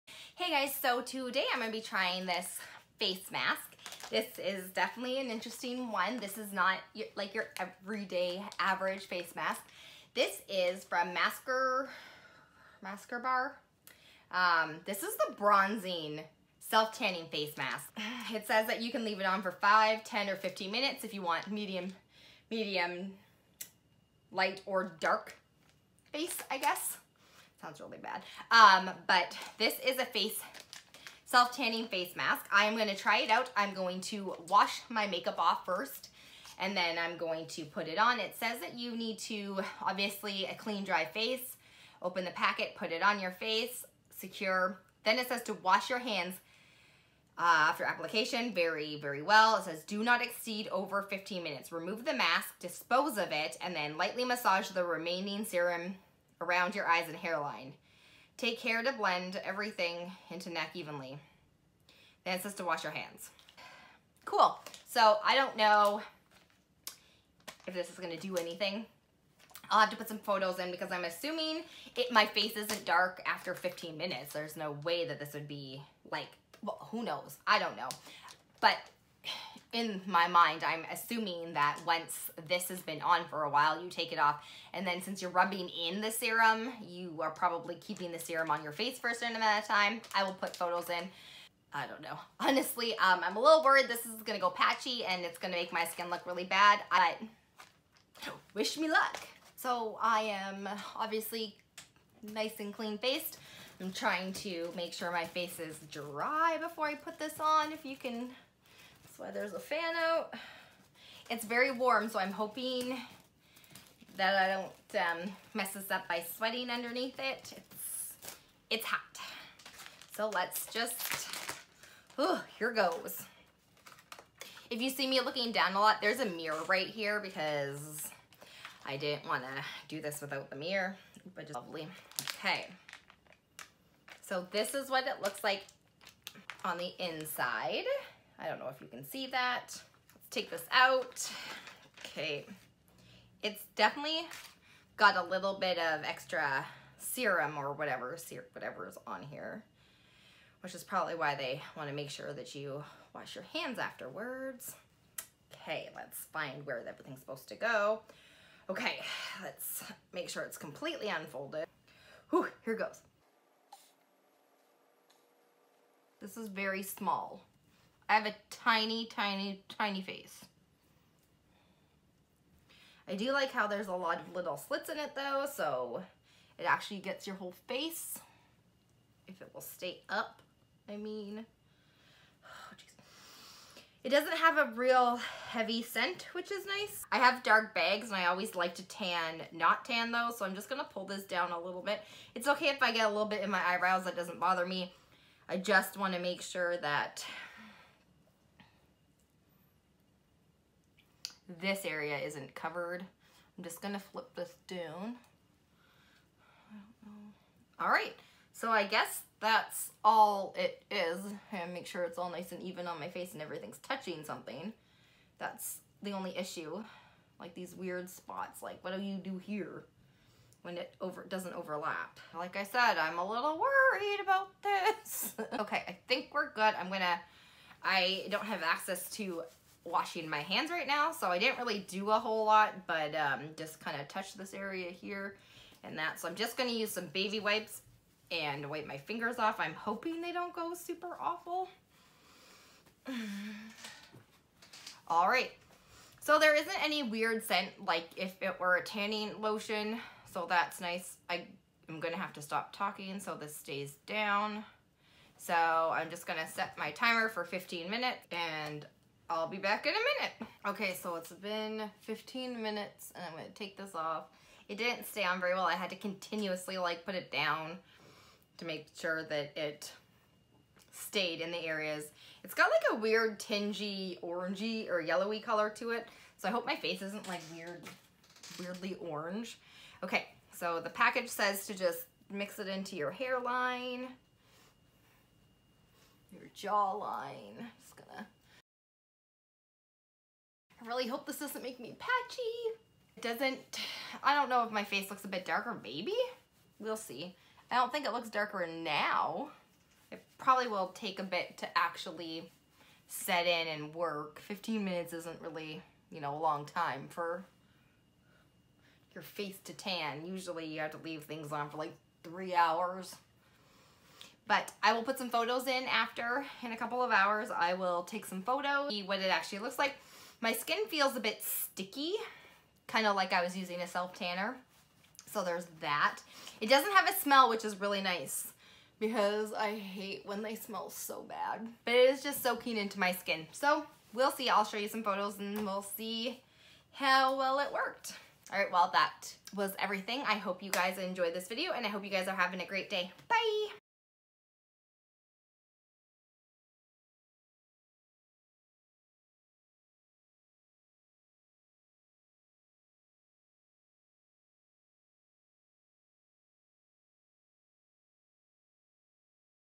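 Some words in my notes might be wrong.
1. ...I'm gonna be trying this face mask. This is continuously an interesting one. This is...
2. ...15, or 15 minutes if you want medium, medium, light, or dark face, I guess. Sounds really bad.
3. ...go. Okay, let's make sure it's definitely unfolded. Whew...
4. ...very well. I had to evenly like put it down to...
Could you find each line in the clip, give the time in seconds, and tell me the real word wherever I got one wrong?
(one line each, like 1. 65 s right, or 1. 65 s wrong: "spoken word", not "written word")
1. 1 s wrong: "definitely", not "continuously"
2. 20 s wrong: "10", not "15"
3. 157 s wrong: "completely", not "definitely"
4. 265 s wrong: "continuously", not "evenly".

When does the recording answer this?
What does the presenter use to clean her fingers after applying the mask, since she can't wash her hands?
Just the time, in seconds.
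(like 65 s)
237 s.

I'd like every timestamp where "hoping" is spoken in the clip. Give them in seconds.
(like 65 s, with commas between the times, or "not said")
112 s, 239 s.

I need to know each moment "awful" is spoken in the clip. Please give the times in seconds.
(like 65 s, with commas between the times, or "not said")
241 s.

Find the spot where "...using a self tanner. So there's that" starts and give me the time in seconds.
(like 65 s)
323 s.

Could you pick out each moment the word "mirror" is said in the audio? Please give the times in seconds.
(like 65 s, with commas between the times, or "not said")
126 s, 130 s.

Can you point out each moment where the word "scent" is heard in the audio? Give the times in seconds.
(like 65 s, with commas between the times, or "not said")
185 s, 247 s.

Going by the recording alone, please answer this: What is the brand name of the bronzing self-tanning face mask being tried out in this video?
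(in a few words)
Masker Bar.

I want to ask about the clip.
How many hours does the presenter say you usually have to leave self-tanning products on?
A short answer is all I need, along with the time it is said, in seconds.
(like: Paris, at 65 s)
3 hours, at 312 s.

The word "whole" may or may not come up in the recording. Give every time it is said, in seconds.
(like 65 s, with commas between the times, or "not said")
177 s, 232 s.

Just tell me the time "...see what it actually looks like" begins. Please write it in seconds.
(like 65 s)
318 s.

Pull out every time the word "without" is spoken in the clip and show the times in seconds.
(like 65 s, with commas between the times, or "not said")
130 s.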